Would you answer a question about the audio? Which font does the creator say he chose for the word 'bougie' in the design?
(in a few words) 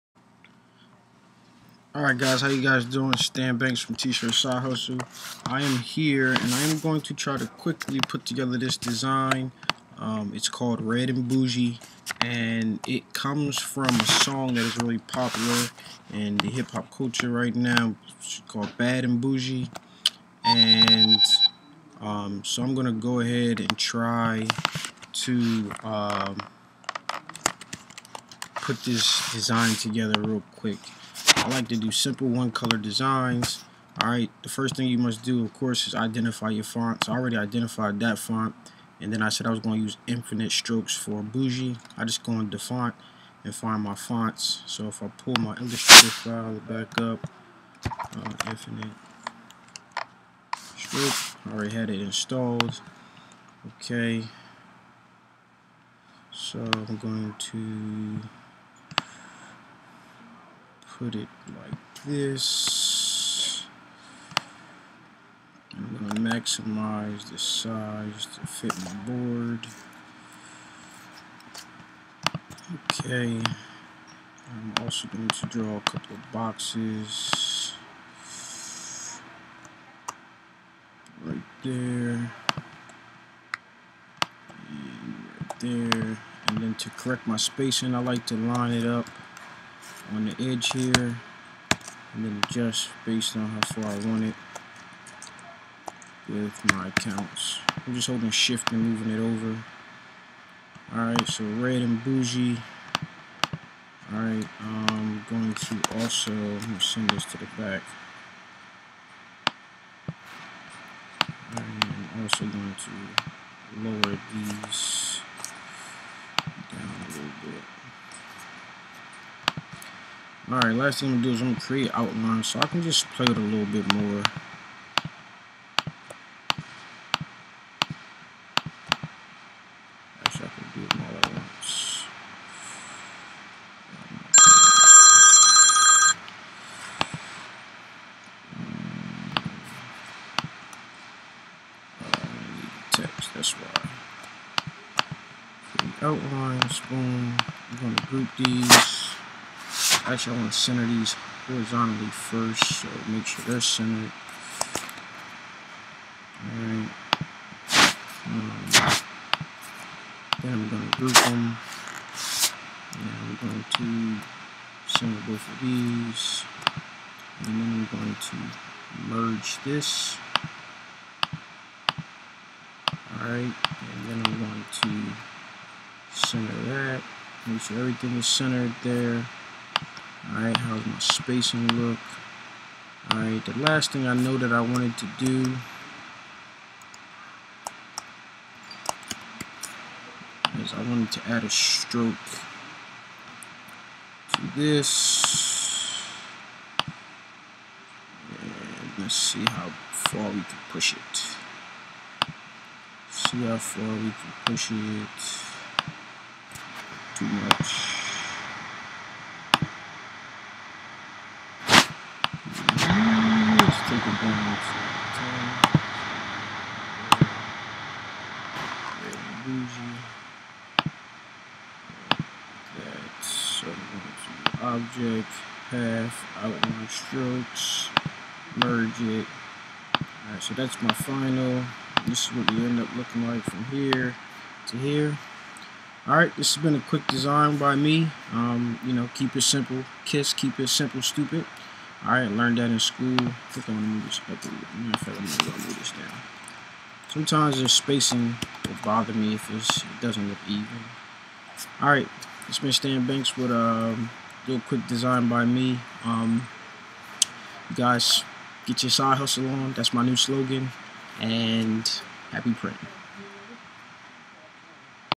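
Infinite Stroke.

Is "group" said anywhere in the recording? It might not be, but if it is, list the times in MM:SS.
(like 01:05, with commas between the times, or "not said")
02:28, 02:40.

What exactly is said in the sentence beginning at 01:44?
Alright, I'm going to also send this to the back.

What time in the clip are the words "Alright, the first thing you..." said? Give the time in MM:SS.
00:34.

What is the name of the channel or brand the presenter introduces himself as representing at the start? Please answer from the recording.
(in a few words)
T-Shirt Side Hustle.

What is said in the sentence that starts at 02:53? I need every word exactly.
Alright, and then I'm going to center that.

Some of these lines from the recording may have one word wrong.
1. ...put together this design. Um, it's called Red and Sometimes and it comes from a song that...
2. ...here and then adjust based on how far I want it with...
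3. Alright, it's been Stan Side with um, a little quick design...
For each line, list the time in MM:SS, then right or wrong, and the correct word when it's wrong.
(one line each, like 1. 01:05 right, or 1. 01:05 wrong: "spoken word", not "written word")
1. 00:08 wrong: "Bougie", not "Sometimes"
2. 01:30 right
3. 04:11 wrong: "Banks", not "Side".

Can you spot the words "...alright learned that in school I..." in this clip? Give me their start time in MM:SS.
04:02.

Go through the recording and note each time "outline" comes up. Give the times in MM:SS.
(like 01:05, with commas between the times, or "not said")
02:01, 02:26, 03:46.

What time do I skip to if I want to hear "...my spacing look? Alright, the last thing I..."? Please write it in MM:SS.
03:00.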